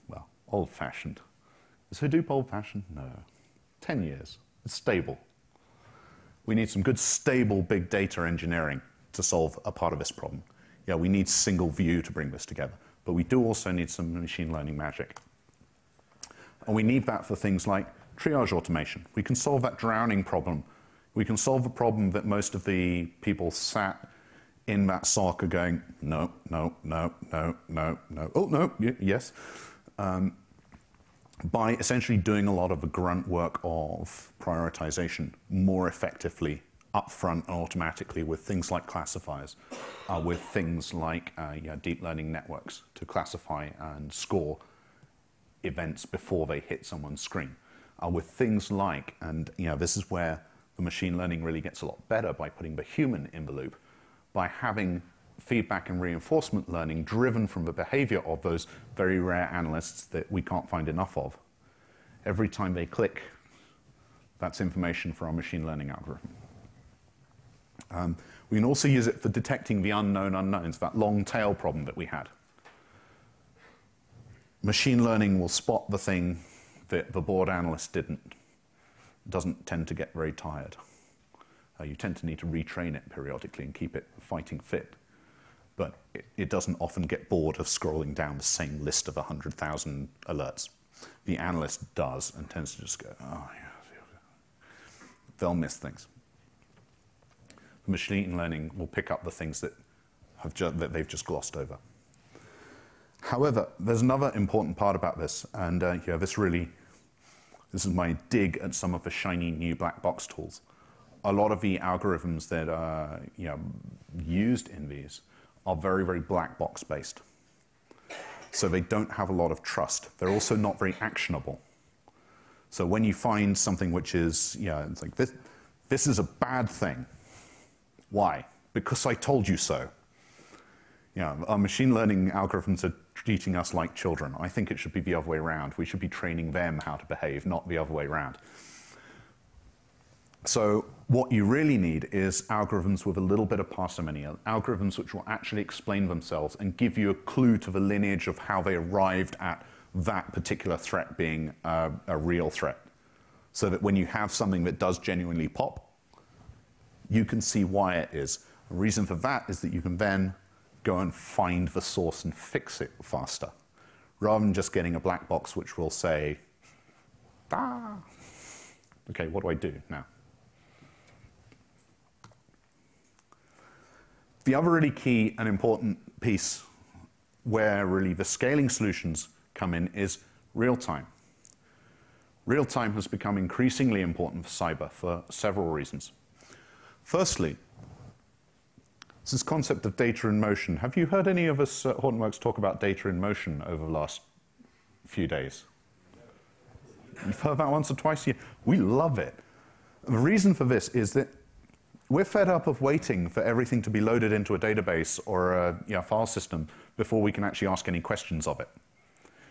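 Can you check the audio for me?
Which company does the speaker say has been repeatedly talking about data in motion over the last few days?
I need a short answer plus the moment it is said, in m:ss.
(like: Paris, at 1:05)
Hortonworks, at 3:11.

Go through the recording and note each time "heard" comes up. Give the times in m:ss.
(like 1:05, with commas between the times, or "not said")
3:11, 3:17.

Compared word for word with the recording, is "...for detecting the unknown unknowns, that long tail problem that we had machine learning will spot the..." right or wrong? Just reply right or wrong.
right.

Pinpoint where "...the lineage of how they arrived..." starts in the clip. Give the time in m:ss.
2:27.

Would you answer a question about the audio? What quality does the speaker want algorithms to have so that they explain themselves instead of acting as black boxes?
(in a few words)
parsimony.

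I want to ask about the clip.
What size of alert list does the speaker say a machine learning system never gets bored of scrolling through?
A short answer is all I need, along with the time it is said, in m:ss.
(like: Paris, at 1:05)
100,000, at 1:29.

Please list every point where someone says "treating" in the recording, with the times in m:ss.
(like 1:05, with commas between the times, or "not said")
2:13.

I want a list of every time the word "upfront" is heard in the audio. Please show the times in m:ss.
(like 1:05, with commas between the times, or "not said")
0:36.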